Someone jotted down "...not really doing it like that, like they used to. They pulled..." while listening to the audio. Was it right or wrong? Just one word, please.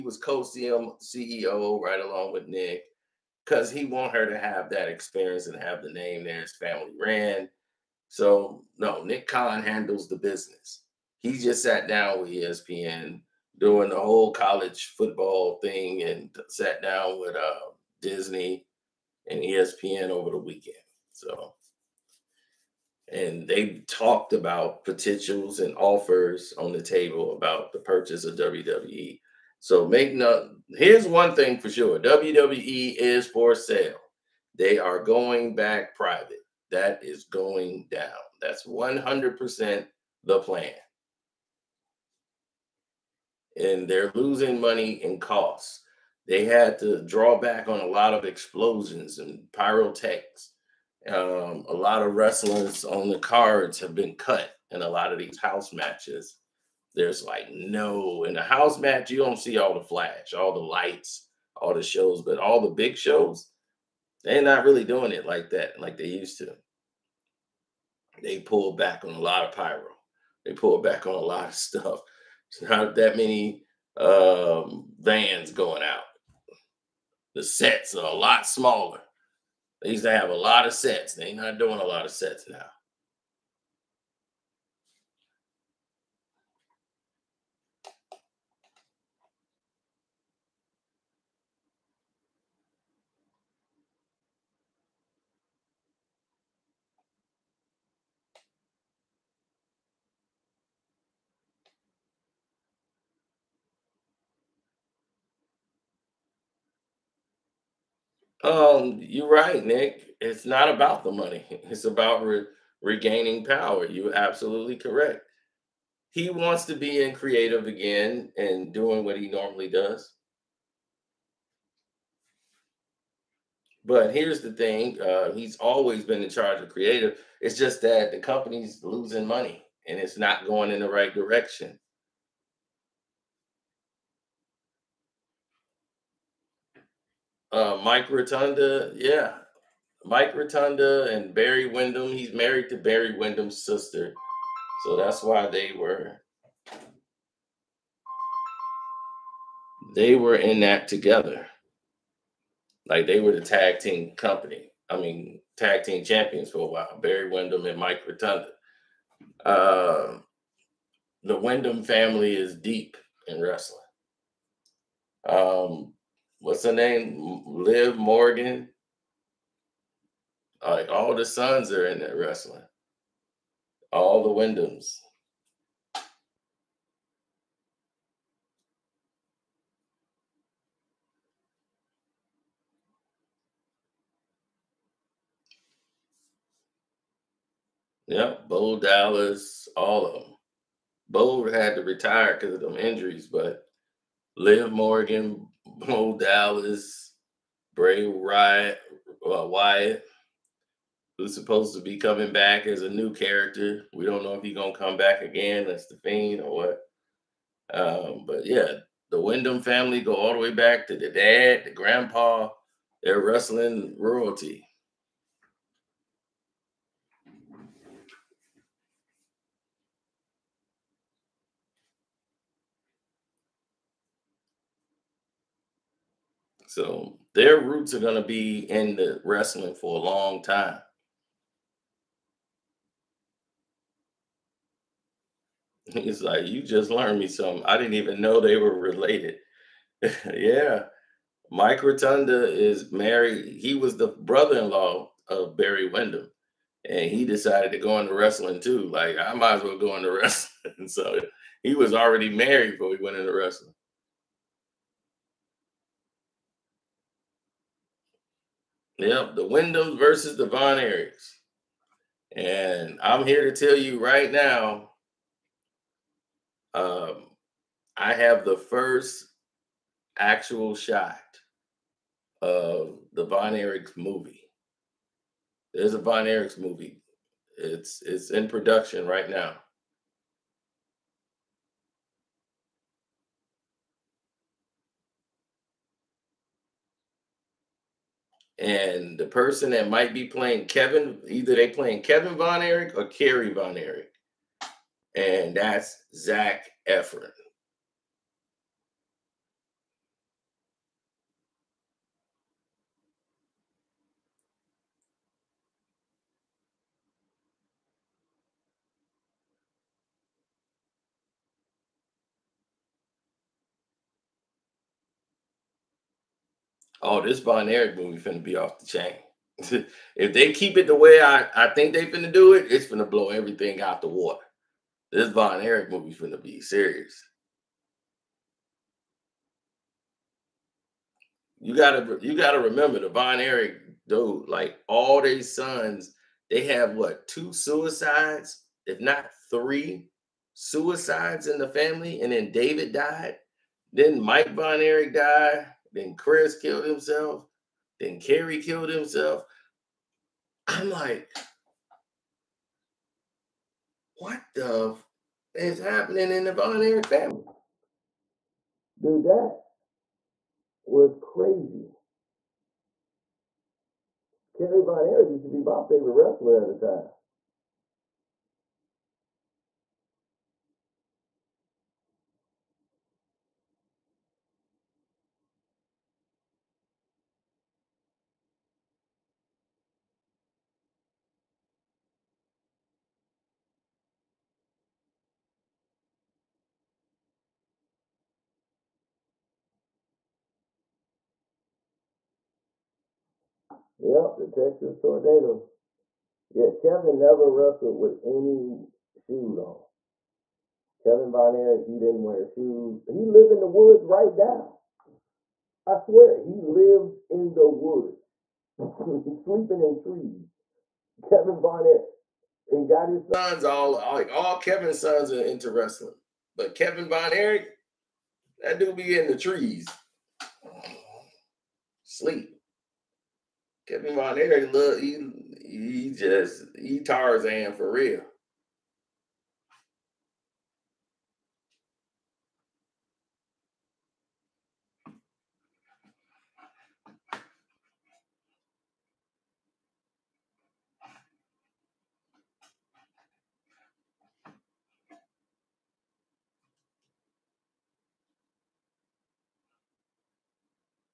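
right.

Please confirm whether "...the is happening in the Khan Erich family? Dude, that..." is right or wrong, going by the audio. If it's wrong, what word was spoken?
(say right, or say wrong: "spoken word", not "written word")
wrong: "Von", not "Khan".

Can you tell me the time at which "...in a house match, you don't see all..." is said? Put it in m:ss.
0:58.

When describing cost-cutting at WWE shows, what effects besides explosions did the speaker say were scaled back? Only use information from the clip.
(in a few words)
pyrotechs.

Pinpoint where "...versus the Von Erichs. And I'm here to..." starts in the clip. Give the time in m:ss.
4:19.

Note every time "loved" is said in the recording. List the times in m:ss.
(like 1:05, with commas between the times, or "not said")
not said.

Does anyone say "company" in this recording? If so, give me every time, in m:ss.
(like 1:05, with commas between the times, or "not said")
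2:08, 2:34.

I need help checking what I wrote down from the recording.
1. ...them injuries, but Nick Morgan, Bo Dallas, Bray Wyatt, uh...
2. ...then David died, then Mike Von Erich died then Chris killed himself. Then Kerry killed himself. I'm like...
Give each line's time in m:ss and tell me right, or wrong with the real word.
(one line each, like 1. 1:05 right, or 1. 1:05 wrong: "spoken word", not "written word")
1. 3:12 wrong: "Liv", not "Nick"
2. 5:42 right.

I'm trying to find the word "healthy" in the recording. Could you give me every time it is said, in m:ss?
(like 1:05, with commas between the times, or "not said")
not said.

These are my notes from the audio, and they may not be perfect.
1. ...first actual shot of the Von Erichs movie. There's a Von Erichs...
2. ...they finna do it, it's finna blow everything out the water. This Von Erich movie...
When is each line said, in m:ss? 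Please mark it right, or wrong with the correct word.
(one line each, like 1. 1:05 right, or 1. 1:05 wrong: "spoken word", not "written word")
1. 4:28 right
2. 5:21 right.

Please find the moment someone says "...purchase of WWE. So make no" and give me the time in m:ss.
0:27.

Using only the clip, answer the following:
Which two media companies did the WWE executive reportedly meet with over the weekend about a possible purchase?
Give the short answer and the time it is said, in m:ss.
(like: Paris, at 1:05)
Disney and ESPN, at 0:17.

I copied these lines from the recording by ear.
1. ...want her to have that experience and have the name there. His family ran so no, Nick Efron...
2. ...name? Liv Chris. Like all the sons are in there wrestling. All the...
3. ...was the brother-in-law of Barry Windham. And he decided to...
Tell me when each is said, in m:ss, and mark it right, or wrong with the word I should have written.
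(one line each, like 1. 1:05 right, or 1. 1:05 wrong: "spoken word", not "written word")
1. 0:03 wrong: "Khan", not "Efron"
2. 2:46 wrong: "Morgan", not "Chris"
3. 4:03 right.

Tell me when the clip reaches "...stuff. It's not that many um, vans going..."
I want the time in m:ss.
1:11.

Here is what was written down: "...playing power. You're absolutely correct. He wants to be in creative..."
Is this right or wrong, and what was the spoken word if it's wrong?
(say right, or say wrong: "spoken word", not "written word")
wrong: "regaining", not "playing".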